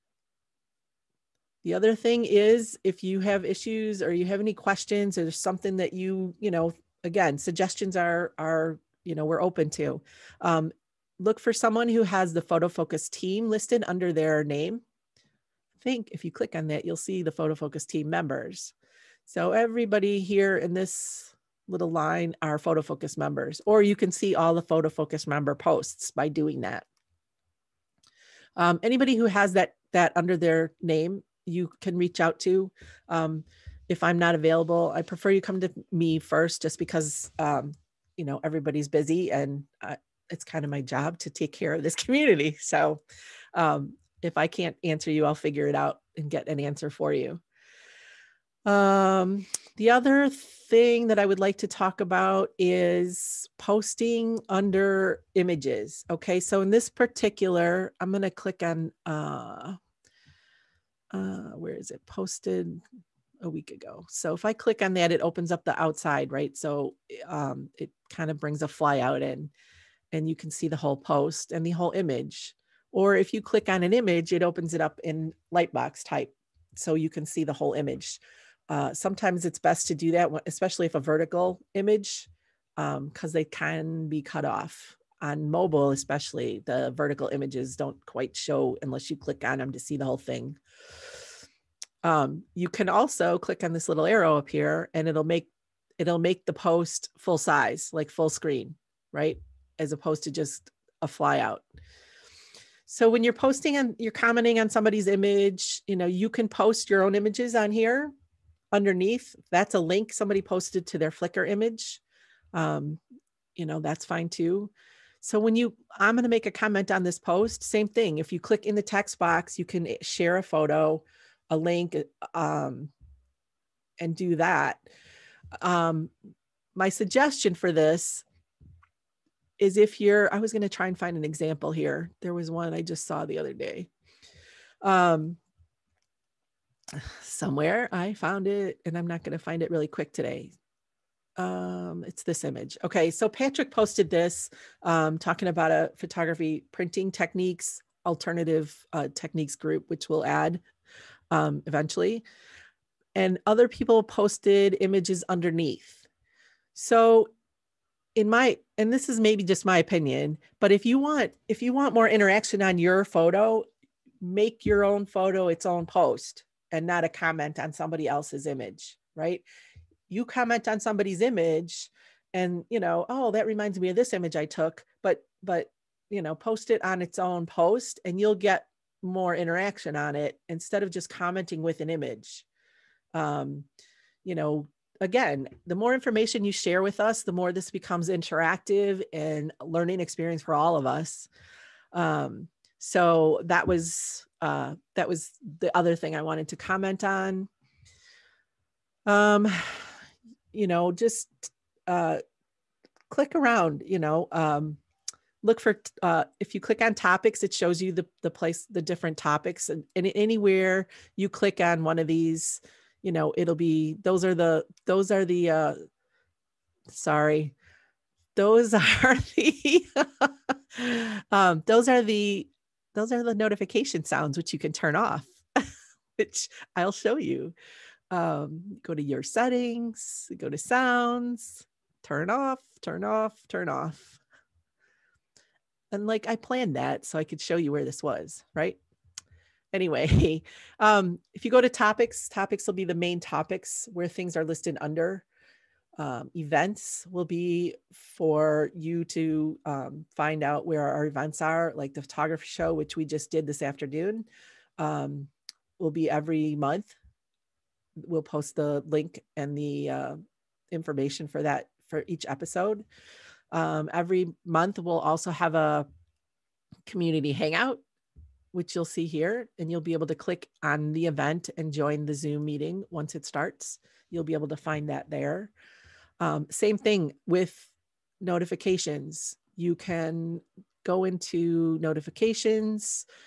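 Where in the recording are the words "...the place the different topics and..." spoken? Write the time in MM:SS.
03:28.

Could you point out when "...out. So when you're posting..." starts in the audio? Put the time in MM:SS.
01:41.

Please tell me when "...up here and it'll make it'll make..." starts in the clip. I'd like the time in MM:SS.
01:34.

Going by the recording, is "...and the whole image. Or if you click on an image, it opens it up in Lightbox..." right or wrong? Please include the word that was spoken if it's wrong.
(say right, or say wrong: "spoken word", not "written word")
right.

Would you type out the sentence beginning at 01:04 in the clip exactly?
So if I click on that, it opens up the outside, right?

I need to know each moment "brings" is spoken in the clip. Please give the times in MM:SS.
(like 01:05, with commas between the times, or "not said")
01:08.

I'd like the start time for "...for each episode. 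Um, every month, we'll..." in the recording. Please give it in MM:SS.
04:21.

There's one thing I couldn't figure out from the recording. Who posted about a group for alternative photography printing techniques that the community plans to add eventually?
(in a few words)
Patrick.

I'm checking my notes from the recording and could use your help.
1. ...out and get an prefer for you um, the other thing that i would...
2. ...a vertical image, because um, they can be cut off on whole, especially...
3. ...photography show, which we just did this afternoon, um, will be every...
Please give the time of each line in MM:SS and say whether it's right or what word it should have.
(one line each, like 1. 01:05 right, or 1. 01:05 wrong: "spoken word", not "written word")
1. 00:45 wrong: "answer", not "prefer"
2. 01:20 wrong: "mobile", not "whole"
3. 04:12 right.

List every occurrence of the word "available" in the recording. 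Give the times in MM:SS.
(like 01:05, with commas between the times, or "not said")
00:34.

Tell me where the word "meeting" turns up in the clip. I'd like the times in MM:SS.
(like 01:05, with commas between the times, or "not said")
04:32.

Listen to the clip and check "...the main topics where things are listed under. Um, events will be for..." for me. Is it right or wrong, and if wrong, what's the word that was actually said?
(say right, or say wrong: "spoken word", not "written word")
right.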